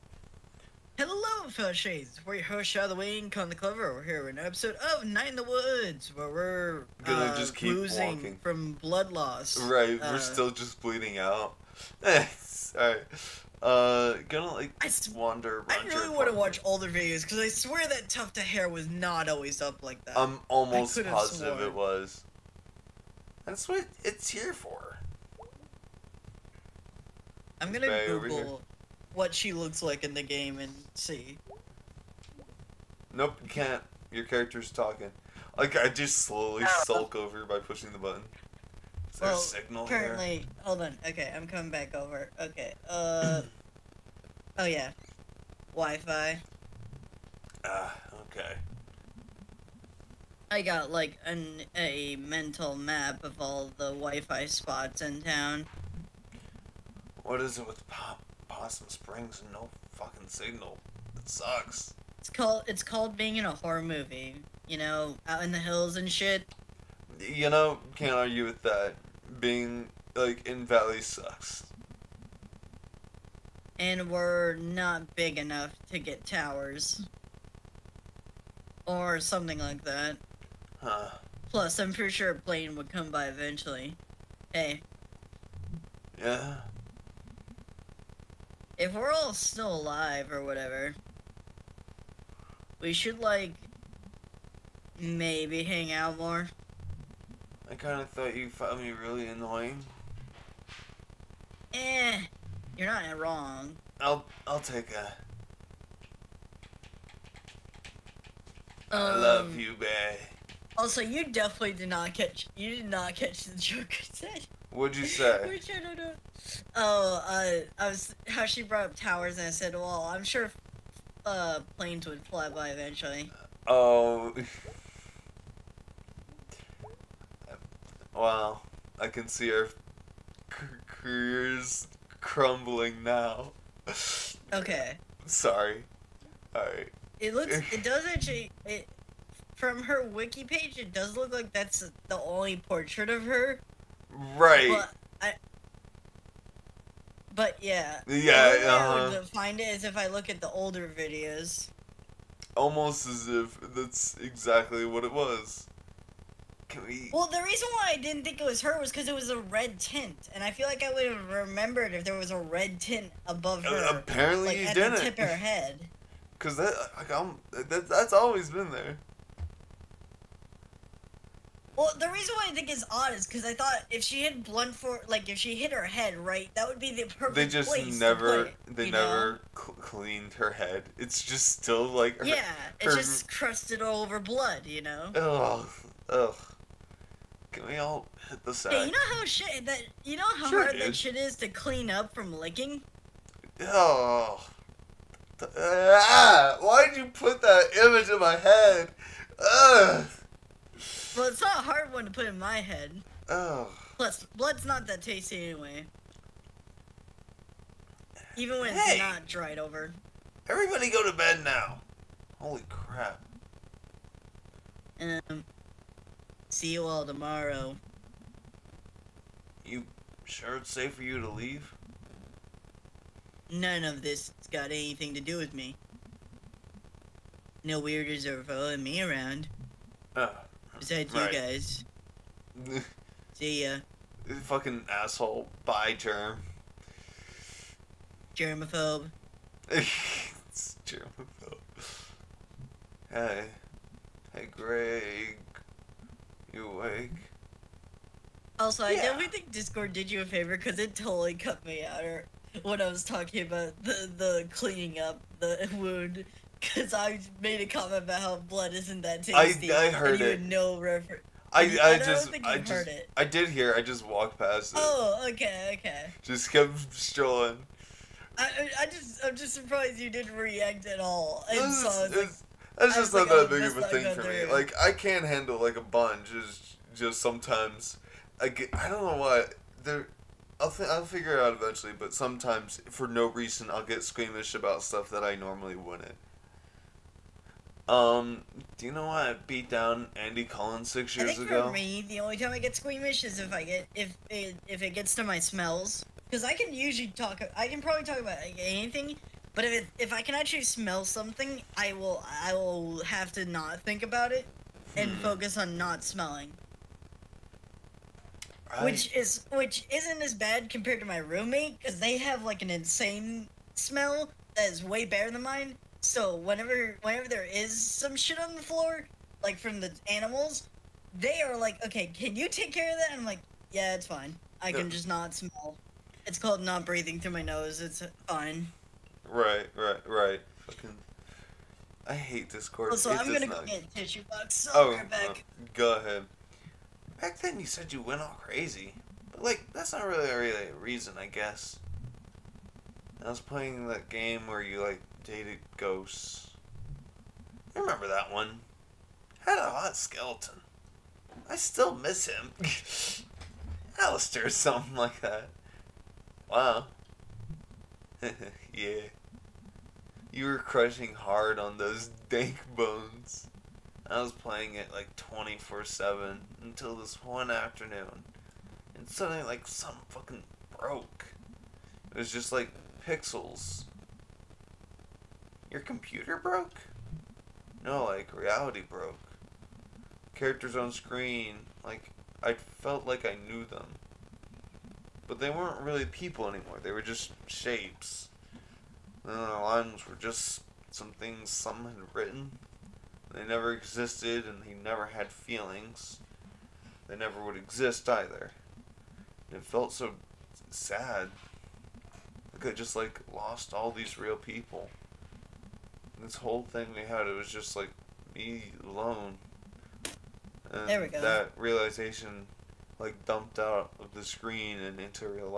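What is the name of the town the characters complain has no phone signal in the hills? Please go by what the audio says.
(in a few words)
Possum Springs.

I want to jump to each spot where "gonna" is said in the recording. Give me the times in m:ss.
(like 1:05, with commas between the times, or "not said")
0:07, 0:14, 0:27, 5:33.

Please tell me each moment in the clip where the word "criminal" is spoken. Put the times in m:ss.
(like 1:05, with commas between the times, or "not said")
not said.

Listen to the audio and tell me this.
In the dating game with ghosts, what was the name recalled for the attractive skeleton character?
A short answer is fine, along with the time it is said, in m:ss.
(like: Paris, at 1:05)
Alistair, at 5:54.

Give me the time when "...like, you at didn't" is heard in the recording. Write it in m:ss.
2:44.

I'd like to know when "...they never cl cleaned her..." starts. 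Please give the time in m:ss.
2:58.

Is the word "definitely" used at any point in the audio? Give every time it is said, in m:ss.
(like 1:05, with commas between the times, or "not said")
1:51, 4:08.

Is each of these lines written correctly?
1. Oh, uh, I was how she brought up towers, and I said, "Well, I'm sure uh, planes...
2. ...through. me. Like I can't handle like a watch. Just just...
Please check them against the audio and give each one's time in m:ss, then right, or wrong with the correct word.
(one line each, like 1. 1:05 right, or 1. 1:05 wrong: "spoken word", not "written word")
1. 1:56 right
2. 4:34 wrong: "bunch", not "watch".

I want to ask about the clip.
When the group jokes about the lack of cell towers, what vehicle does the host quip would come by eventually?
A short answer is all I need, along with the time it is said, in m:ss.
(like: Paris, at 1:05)
a plane, at 1:22.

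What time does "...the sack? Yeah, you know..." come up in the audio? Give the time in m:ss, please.
3:08.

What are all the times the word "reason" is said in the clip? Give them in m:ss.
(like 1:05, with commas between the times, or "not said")
2:37, 2:52, 4:43, 5:40.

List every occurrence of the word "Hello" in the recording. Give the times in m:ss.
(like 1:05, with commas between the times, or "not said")
0:00.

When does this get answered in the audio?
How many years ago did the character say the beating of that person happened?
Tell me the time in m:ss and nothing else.
4:50.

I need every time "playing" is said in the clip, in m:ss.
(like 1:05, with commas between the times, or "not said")
5:43, 6:04.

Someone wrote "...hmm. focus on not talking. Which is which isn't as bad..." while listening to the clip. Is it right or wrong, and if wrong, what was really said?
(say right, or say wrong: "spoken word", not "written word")
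wrong: "smelling", not "talking".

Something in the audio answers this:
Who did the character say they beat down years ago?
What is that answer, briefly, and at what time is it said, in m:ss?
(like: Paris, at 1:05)
Andy Collins, at 4:50.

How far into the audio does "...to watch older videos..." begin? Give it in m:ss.
0:16.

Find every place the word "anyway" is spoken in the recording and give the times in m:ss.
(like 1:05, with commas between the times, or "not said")
3:25.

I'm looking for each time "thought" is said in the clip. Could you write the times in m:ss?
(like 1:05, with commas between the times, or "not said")
1:38, 2:53.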